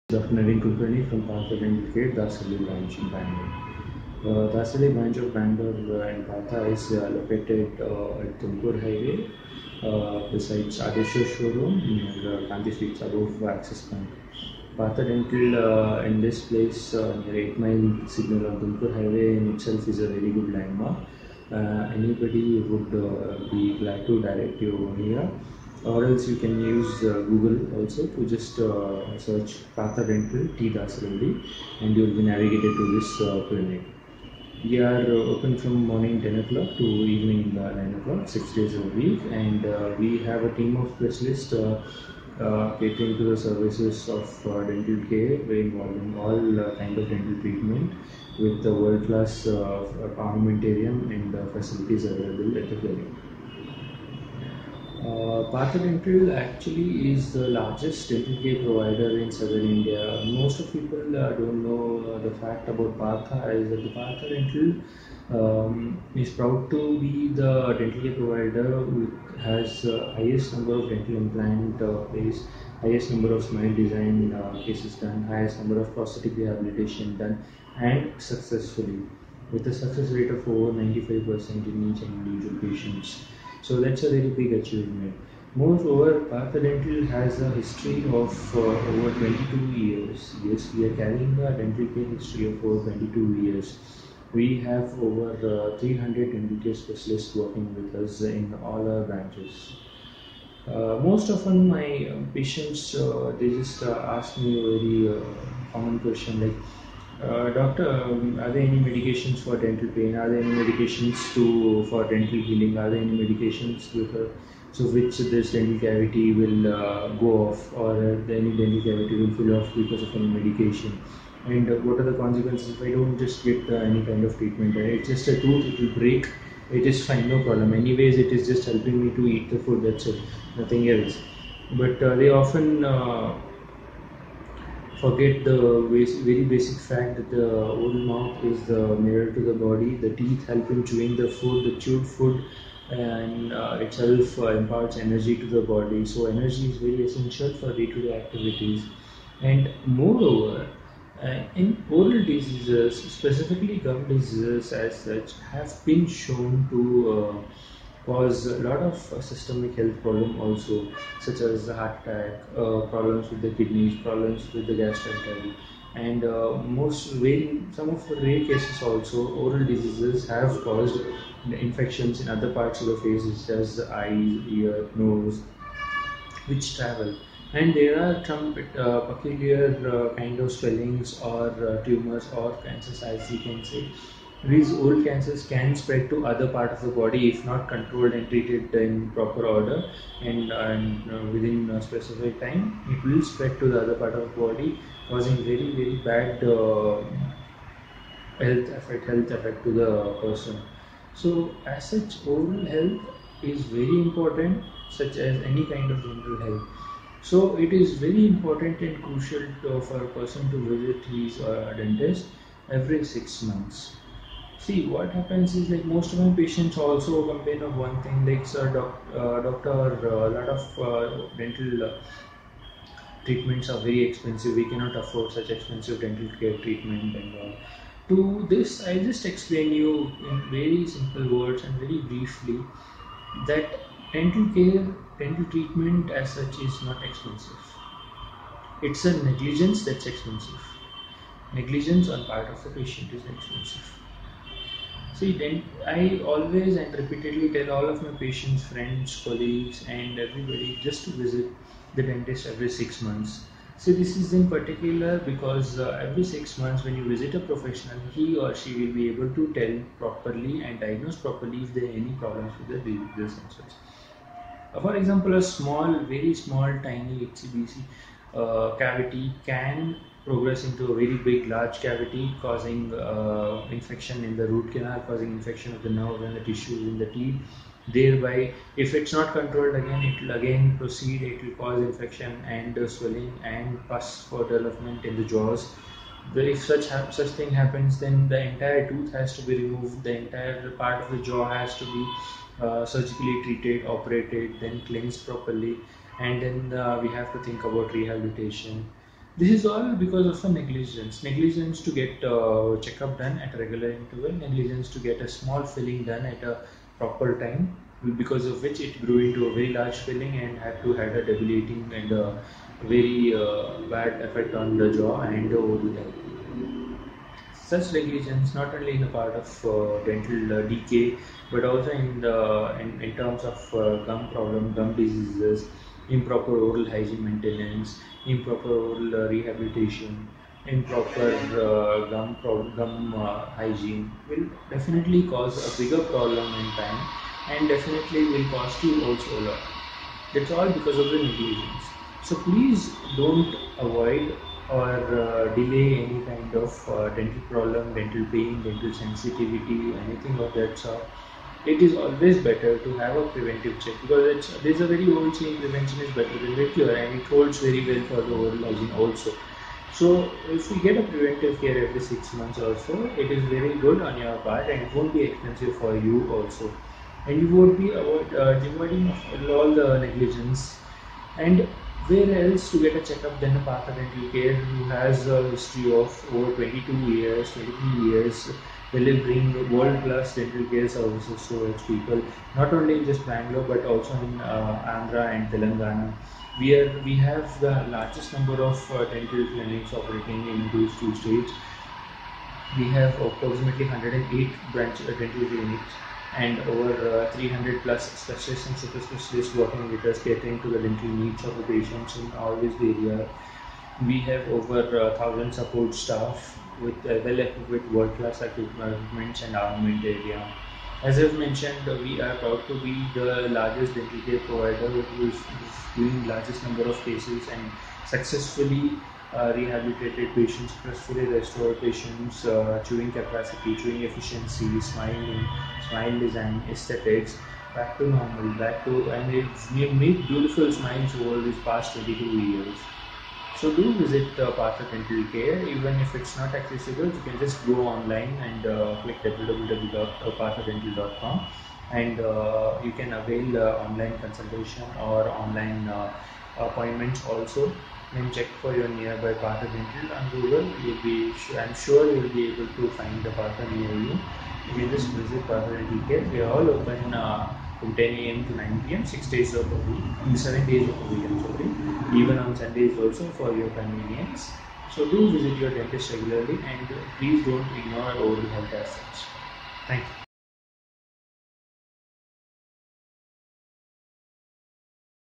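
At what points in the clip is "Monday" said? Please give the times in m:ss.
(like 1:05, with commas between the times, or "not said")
not said.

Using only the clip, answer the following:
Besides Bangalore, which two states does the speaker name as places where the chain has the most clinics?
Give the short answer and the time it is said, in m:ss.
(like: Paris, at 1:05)
Andhra and Telangana, at 6:24.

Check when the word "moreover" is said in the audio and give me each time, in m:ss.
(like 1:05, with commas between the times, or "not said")
1:25, 2:29.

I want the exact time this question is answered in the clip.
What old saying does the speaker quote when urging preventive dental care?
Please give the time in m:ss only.
5:55.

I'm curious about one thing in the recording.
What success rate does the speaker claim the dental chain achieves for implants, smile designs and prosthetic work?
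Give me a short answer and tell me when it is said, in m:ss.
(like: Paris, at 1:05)
over 95%, at 1:19.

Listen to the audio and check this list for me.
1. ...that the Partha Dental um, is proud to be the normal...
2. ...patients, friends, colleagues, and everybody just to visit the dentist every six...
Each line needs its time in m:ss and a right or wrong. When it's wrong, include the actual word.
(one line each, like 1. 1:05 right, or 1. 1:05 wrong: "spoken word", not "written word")
1. 1:03 wrong: "dental", not "normal"
2. 4:08 right.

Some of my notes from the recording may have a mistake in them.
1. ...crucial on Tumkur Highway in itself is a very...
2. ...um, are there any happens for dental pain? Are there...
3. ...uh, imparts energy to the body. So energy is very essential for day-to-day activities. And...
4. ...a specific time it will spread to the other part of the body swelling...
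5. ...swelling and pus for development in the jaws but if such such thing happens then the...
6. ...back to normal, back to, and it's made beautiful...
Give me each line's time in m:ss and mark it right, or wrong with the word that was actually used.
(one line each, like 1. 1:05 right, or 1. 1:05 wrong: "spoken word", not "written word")
1. 0:18 wrong: "signal", not "crucial"
2. 1:47 wrong: "medications", not "happens"
3. 2:24 right
4. 3:11 wrong: "causing", not "swelling"
5. 4:42 right
6. 7:07 right.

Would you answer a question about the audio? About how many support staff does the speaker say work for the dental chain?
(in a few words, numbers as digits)
over 1,000.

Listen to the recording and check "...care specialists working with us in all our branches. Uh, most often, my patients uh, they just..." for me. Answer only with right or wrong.
right.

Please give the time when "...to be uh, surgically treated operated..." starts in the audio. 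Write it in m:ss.
4:51.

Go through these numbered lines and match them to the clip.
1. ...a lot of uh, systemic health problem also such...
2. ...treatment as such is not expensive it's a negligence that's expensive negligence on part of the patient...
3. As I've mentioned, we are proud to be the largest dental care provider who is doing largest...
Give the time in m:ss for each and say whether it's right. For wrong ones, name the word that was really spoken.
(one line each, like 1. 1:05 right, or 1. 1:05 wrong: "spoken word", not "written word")
1. 2:38 right
2. 3:55 right
3. 6:51 right.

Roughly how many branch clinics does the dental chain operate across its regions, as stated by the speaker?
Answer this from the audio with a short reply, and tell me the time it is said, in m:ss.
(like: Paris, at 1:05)
108, at 6:33.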